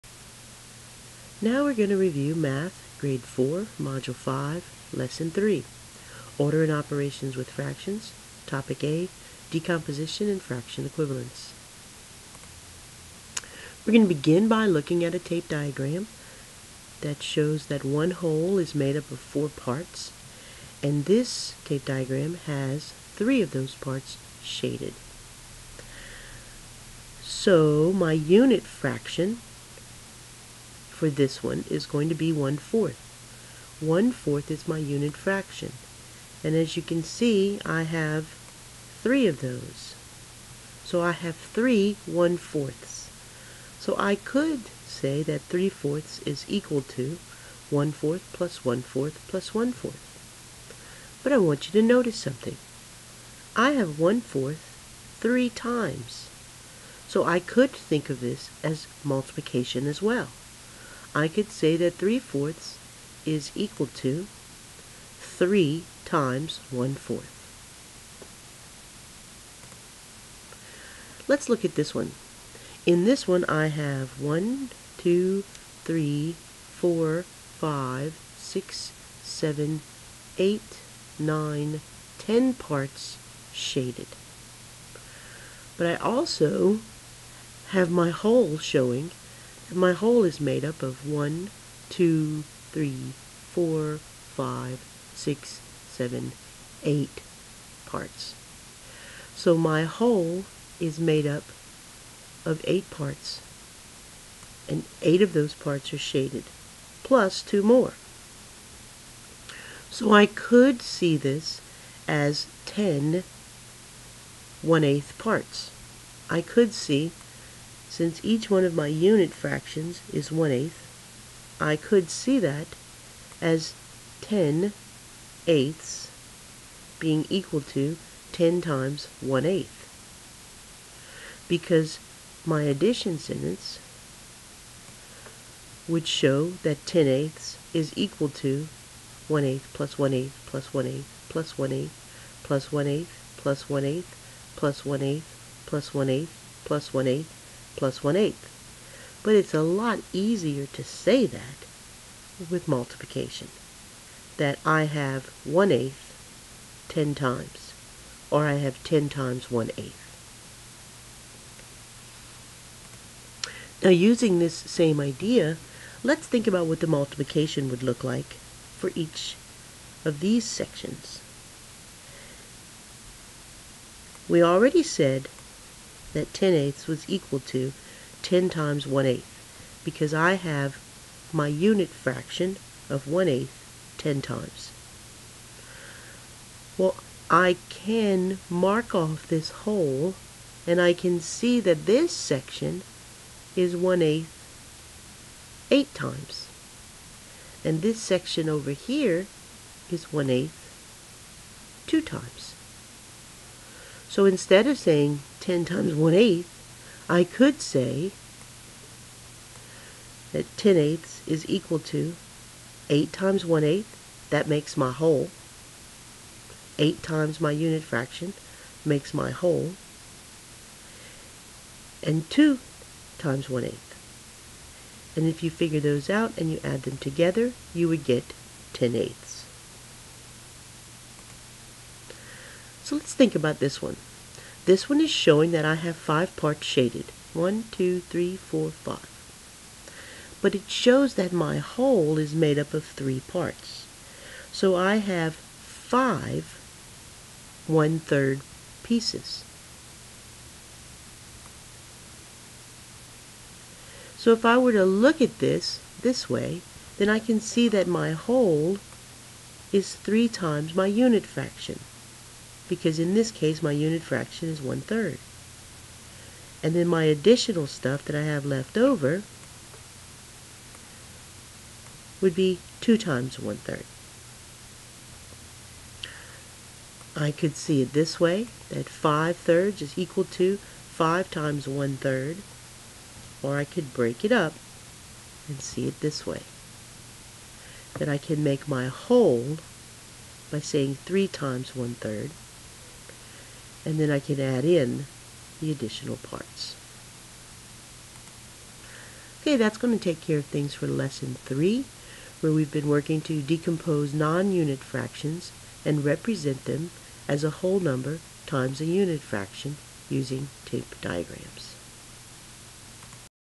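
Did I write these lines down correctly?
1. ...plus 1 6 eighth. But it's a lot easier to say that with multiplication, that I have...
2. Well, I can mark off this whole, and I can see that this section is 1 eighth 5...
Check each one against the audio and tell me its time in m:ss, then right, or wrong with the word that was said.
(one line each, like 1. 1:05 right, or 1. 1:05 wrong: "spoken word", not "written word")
1. 2:27 wrong: "1", not "6"
2. 3:06 wrong: "8", not "5".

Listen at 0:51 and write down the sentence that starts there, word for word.
But I want you to notice something.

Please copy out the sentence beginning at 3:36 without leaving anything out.
8 times my unit fraction makes my whole.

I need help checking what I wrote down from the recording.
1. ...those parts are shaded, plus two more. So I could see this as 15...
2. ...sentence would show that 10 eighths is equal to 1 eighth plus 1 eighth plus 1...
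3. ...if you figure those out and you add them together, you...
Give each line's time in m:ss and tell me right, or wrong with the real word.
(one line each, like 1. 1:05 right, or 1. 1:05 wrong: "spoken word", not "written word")
1. 1:45 wrong: "10", not "15"
2. 2:13 right
3. 3:45 right.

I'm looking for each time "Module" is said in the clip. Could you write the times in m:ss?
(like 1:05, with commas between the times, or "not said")
0:03.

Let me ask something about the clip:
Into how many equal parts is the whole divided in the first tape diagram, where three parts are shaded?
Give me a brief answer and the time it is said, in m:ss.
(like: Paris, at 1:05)
4, at 0:19.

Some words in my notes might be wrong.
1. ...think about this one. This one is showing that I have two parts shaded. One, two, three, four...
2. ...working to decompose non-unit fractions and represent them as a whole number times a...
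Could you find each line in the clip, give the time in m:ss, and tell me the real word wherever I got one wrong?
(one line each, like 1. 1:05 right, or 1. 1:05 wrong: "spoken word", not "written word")
1. 3:53 wrong: "five", not "two"
2. 5:02 right.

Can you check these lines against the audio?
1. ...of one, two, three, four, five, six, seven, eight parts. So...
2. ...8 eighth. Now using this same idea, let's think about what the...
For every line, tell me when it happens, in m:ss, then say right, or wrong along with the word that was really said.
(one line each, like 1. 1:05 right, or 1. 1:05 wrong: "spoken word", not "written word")
1. 1:30 right
2. 2:39 wrong: "1", not "8".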